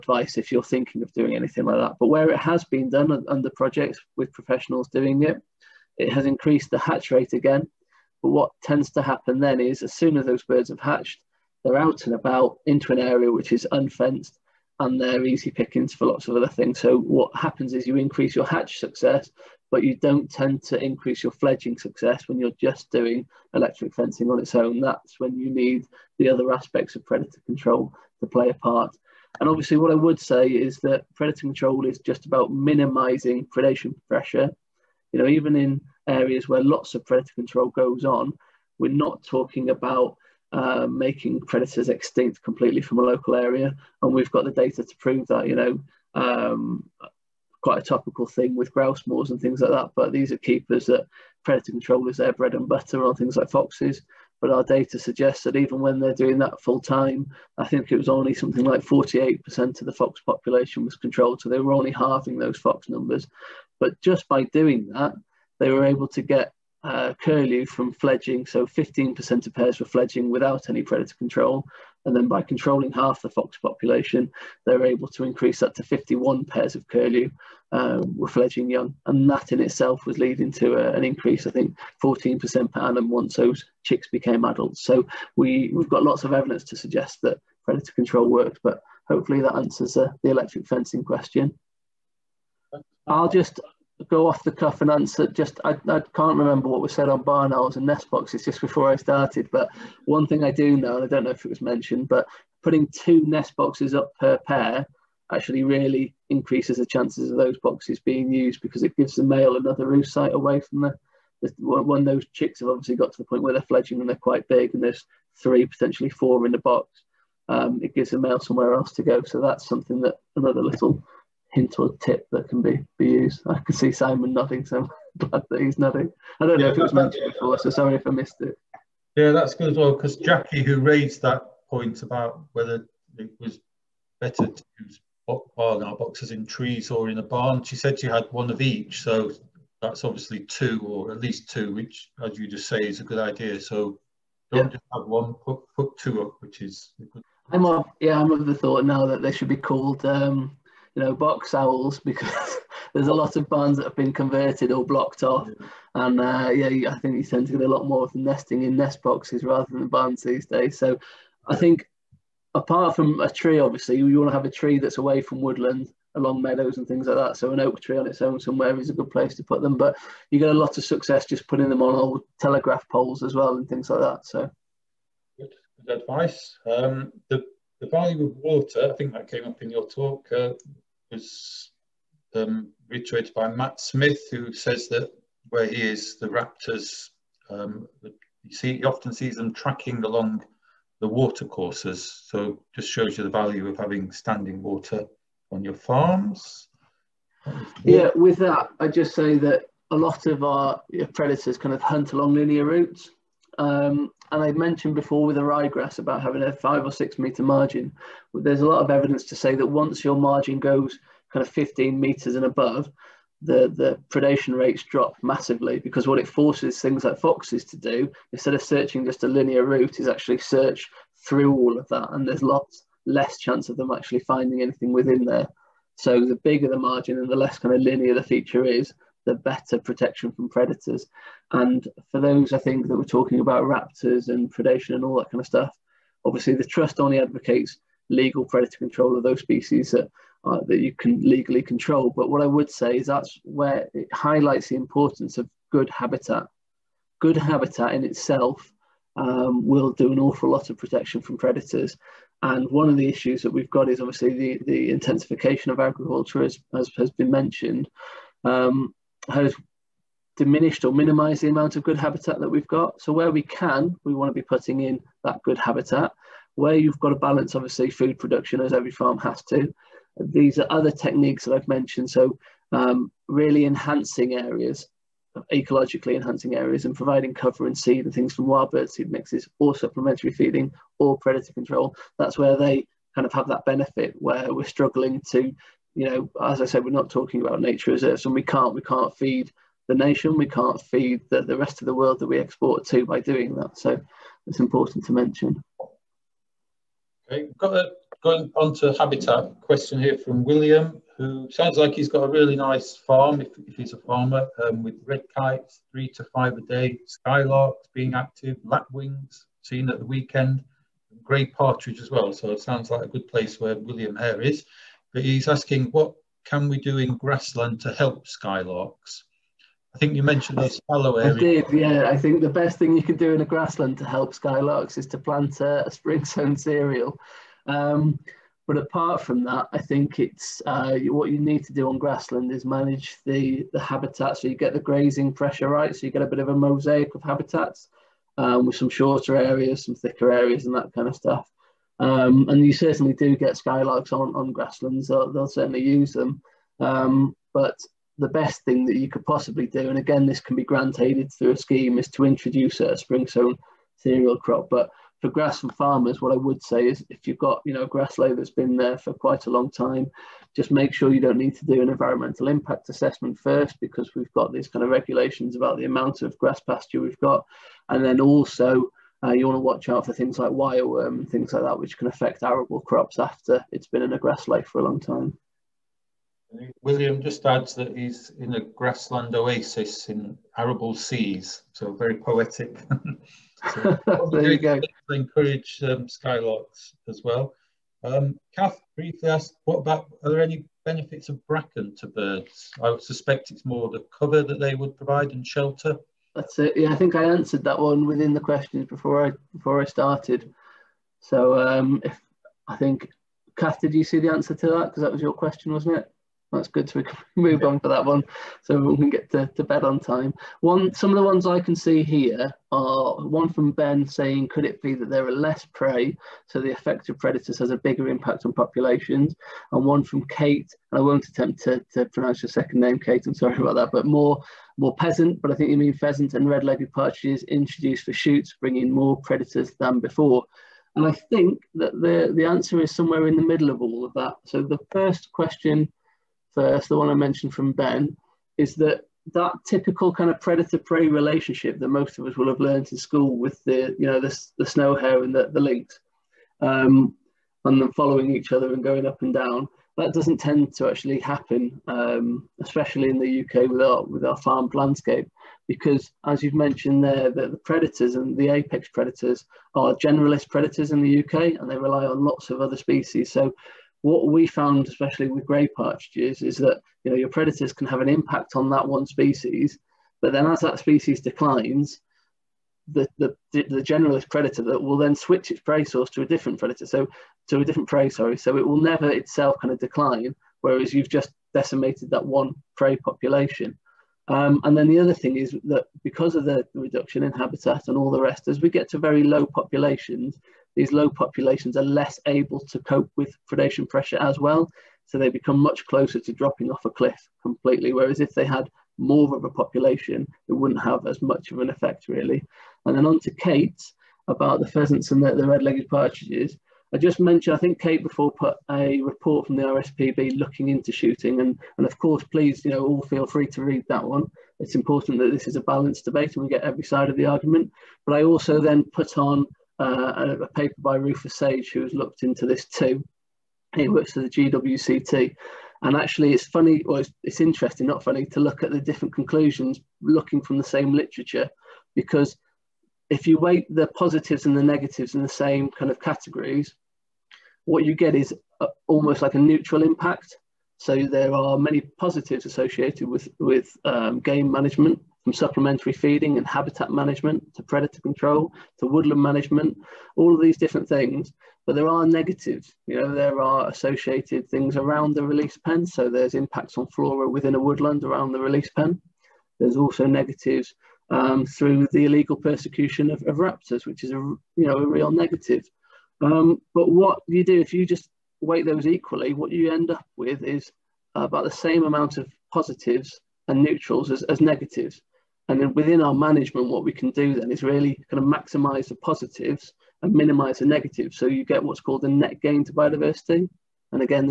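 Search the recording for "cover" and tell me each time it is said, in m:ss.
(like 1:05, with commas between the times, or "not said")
4:37, 6:34.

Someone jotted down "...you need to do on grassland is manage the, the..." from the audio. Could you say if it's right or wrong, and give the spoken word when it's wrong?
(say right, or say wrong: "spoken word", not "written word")
right.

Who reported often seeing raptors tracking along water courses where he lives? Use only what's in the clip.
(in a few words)
Matt Smith.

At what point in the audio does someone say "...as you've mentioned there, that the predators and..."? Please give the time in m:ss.
7:36.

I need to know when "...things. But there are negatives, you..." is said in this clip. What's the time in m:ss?
9:10.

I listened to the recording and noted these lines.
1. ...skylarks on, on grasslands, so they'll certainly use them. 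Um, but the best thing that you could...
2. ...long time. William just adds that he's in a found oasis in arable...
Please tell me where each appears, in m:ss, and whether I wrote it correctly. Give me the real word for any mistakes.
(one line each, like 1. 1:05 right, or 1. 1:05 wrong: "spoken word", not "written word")
1. 5:43 right
2. 6:14 wrong: "grassland", not "found".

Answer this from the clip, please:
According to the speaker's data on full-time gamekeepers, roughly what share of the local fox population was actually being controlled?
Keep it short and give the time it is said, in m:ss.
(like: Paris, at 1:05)
48%, at 0:58.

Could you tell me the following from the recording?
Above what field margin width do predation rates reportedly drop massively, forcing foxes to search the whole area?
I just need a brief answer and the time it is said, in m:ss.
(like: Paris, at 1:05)
15 metres, at 3:31.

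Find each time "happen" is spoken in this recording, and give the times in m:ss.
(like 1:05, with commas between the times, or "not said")
0:09, 0:17, 7:31.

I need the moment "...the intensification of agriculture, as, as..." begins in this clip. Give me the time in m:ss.
4:14.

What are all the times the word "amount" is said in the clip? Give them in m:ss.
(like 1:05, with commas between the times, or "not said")
4:21, 6:05, 9:31.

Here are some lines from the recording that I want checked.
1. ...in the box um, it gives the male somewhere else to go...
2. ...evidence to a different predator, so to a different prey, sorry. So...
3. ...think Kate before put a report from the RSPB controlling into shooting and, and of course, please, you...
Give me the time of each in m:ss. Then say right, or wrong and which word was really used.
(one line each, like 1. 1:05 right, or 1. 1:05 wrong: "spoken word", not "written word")
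1. 1:56 right
2. 7:55 wrong: "source", not "evidence"
3. 8:27 wrong: "looking", not "controlling".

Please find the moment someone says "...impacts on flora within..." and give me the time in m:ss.
9:16.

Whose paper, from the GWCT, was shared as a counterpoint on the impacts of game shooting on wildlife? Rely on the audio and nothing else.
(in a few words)
Rufus Sage.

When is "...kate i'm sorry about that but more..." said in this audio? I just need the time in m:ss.
7:02.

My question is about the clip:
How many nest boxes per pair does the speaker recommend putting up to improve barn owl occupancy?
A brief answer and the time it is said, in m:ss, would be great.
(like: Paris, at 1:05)
2, at 1:42.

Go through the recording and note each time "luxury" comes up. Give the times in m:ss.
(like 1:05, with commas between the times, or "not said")
not said.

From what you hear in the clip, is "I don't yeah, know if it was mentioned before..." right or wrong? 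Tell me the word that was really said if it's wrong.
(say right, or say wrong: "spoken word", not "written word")
right.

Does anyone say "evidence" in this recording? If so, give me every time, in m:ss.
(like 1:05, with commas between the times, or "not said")
1:26, 3:28.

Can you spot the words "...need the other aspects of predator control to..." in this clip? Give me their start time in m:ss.
0:25.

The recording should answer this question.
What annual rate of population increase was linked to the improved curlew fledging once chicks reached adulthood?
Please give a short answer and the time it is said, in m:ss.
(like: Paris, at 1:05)
14% per annum, at 1:22.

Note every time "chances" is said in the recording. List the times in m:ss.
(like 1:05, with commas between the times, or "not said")
1:46, 3:43.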